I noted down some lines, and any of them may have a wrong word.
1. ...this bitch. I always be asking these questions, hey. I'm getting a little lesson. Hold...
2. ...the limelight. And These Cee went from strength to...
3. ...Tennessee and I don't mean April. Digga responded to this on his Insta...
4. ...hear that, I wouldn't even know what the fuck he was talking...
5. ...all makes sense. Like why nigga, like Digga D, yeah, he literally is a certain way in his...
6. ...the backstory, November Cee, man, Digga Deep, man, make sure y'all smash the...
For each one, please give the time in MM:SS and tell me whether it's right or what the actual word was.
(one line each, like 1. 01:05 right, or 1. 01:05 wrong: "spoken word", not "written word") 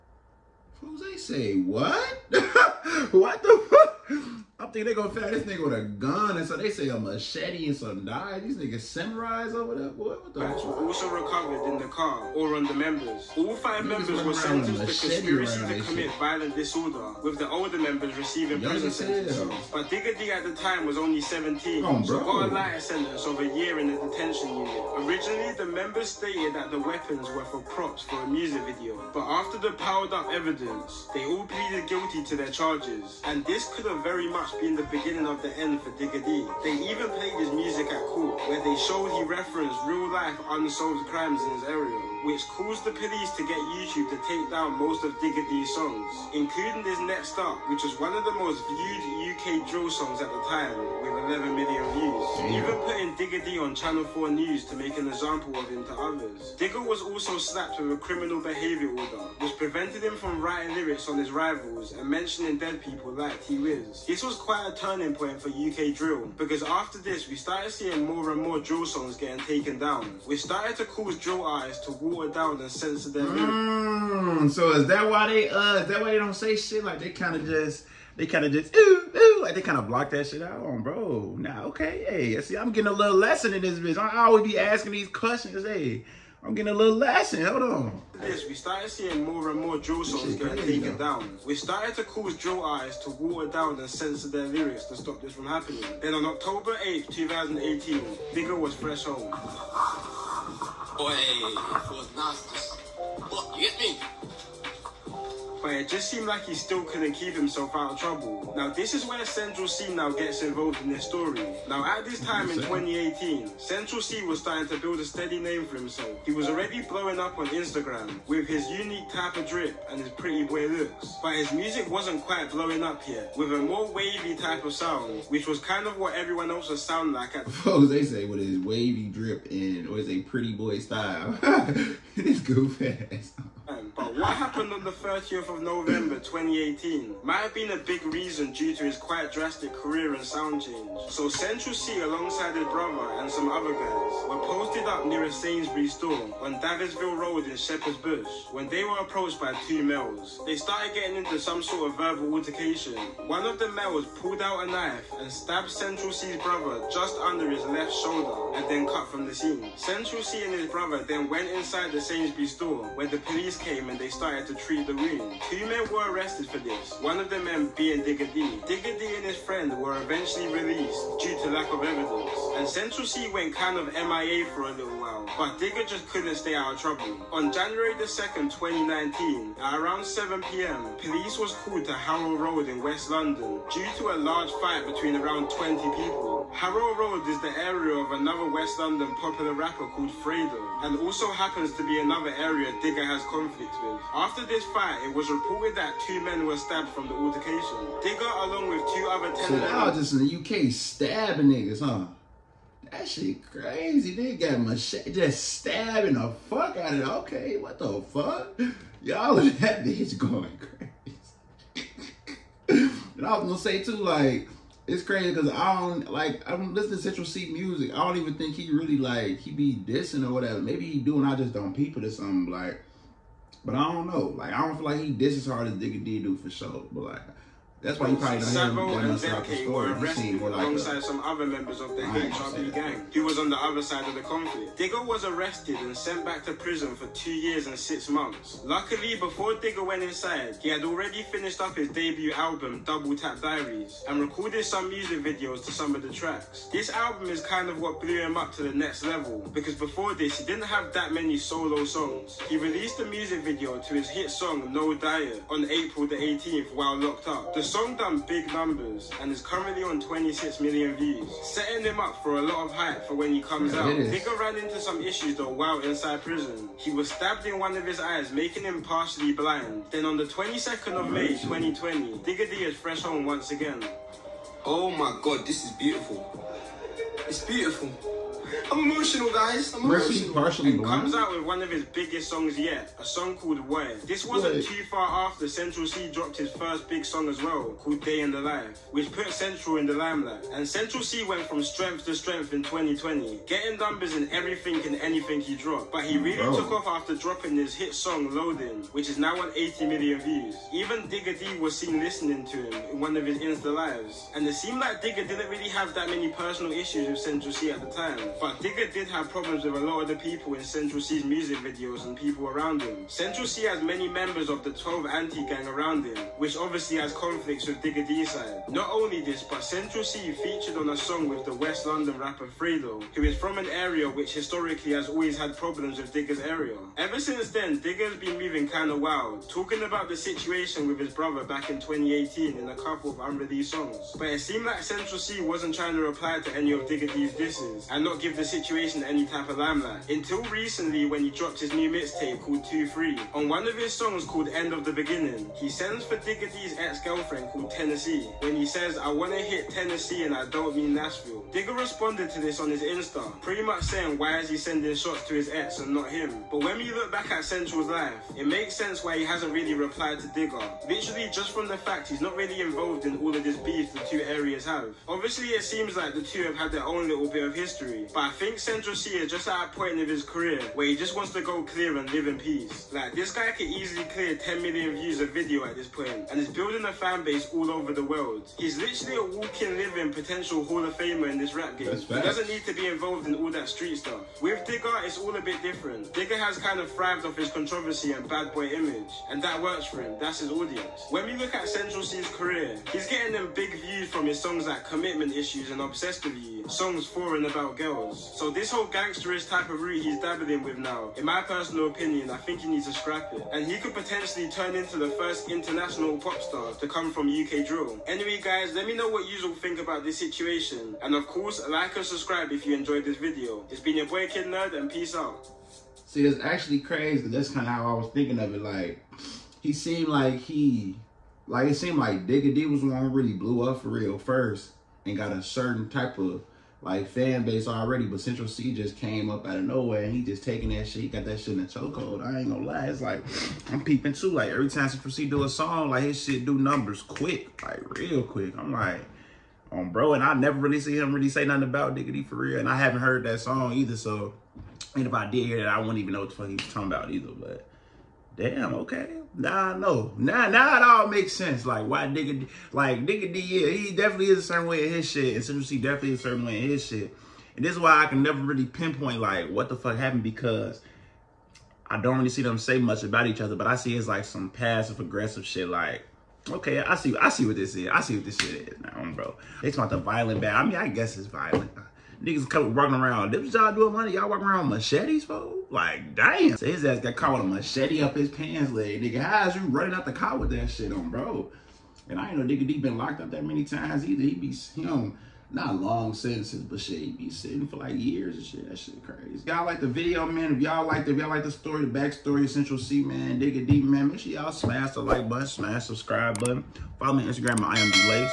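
1. 01:23 right
2. 04:49 wrong: "Central", not "These"
3. 05:49 wrong: "Nashville", not "April"
4. 07:25 right
5. 07:30 wrong: "definitely", not "literally"
6. 08:11 wrong: "Central", not "November".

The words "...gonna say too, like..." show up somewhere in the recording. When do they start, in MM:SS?
03:33.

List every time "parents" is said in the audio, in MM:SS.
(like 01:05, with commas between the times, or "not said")
not said.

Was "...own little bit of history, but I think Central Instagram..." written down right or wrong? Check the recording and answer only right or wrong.
wrong.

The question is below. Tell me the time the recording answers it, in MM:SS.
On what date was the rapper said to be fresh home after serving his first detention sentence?
01:36.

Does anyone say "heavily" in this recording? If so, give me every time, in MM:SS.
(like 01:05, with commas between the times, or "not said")
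not said.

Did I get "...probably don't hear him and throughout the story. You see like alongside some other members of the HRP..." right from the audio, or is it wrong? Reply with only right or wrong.
right.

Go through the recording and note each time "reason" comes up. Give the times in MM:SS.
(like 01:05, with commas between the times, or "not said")
02:18.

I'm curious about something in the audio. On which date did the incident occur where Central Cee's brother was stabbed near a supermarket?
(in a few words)
30th of November 2018.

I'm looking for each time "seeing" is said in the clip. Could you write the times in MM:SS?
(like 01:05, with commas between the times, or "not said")
01:07, 01:28.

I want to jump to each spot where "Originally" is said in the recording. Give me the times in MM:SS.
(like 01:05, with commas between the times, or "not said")
00:25.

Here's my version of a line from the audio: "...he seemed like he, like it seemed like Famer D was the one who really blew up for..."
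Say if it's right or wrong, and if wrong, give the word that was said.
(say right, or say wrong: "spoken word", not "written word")
wrong: "Digga", not "Famer".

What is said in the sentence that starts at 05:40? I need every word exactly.
Until recently, when he dropped his new mixtape called 2 3.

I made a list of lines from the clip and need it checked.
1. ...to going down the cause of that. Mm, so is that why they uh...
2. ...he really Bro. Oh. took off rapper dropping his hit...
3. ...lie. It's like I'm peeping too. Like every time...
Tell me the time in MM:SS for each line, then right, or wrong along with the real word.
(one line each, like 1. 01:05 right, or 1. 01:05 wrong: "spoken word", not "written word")
1. 01:11 wrong: "sense", not "cause"
2. 04:56 wrong: "after", not "rapper"
3. 07:12 right.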